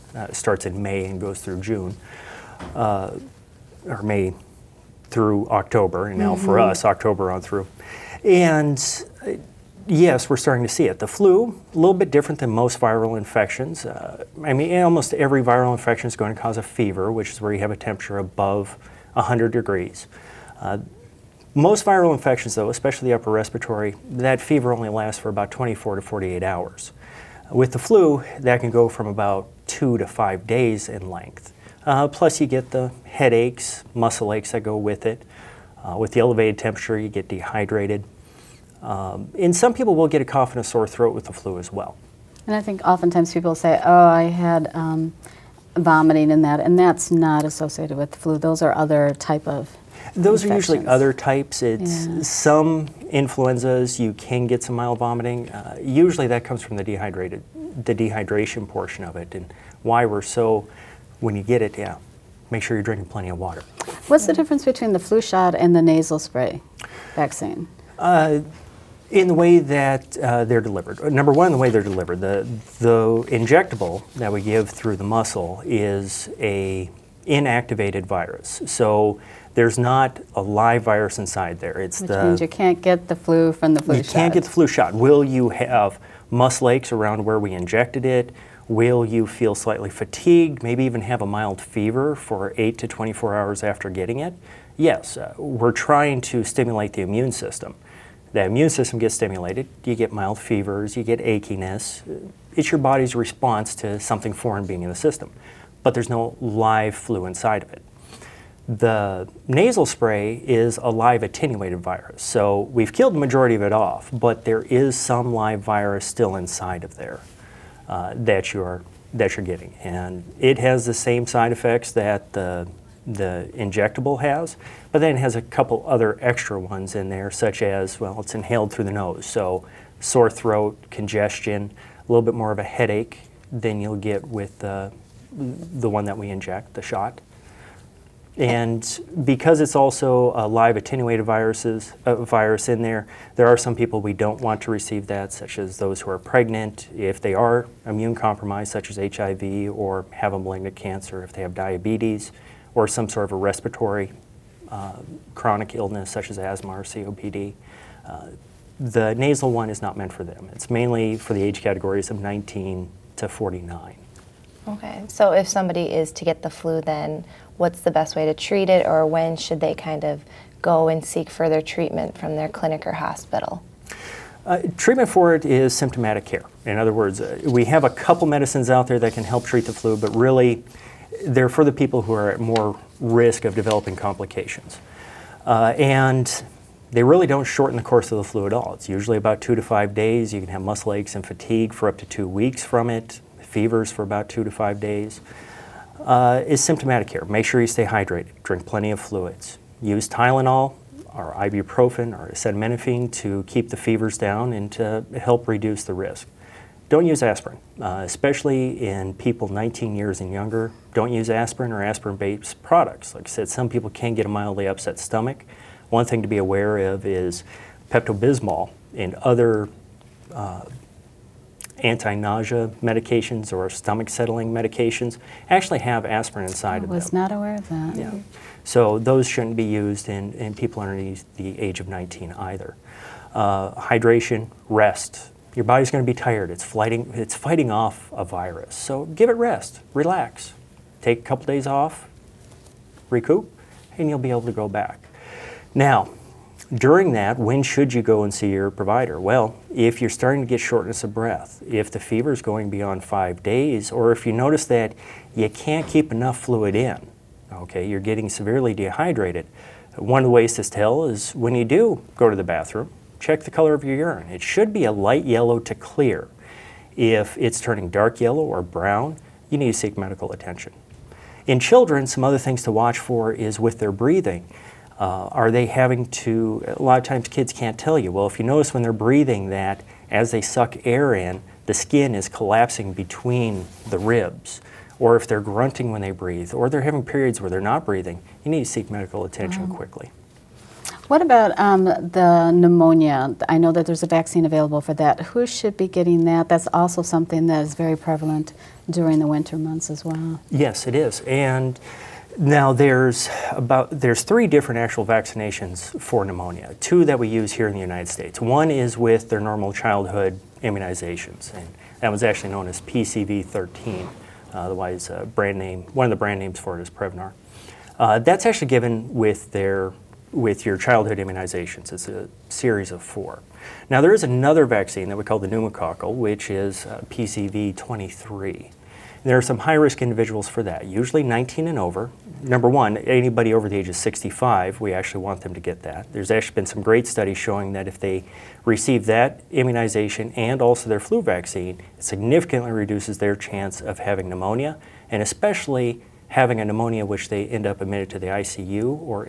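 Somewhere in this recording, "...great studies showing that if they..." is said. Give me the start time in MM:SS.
05:36.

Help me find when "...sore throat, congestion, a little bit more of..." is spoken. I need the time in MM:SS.
02:10.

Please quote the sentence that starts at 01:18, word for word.
So there's not a live virus inside there.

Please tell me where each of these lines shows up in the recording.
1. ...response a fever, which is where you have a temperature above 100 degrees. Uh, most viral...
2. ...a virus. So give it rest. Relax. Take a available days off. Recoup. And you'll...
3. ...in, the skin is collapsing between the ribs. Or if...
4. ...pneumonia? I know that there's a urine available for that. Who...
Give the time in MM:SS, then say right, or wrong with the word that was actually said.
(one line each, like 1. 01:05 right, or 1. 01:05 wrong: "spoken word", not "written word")
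1. 00:16 wrong: "cause", not "response"
2. 03:58 wrong: "couple", not "available"
3. 04:41 right
4. 04:52 wrong: "vaccine", not "urine".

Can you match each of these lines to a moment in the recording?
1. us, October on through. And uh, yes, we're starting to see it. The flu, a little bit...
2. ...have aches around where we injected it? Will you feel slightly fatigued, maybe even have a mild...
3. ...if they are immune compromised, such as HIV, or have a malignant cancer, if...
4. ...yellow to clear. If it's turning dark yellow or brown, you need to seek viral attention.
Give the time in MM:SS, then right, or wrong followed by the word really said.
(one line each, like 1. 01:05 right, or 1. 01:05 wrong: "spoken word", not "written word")
1. 00:06 right
2. 01:25 right
3. 02:26 right
4. 04:25 wrong: "medical", not "viral".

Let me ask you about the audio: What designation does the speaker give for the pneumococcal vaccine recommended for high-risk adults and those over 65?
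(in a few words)
PCV23.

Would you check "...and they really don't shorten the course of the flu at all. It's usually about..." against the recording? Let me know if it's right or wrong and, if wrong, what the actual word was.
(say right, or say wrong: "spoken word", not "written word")
right.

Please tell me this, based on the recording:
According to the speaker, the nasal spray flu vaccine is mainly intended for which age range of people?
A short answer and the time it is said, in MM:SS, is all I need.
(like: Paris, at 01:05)
19 to 49, at 02:42.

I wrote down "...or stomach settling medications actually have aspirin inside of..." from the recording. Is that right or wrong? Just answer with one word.
right.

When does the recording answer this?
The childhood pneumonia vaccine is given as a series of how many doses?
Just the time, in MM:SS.
05:23.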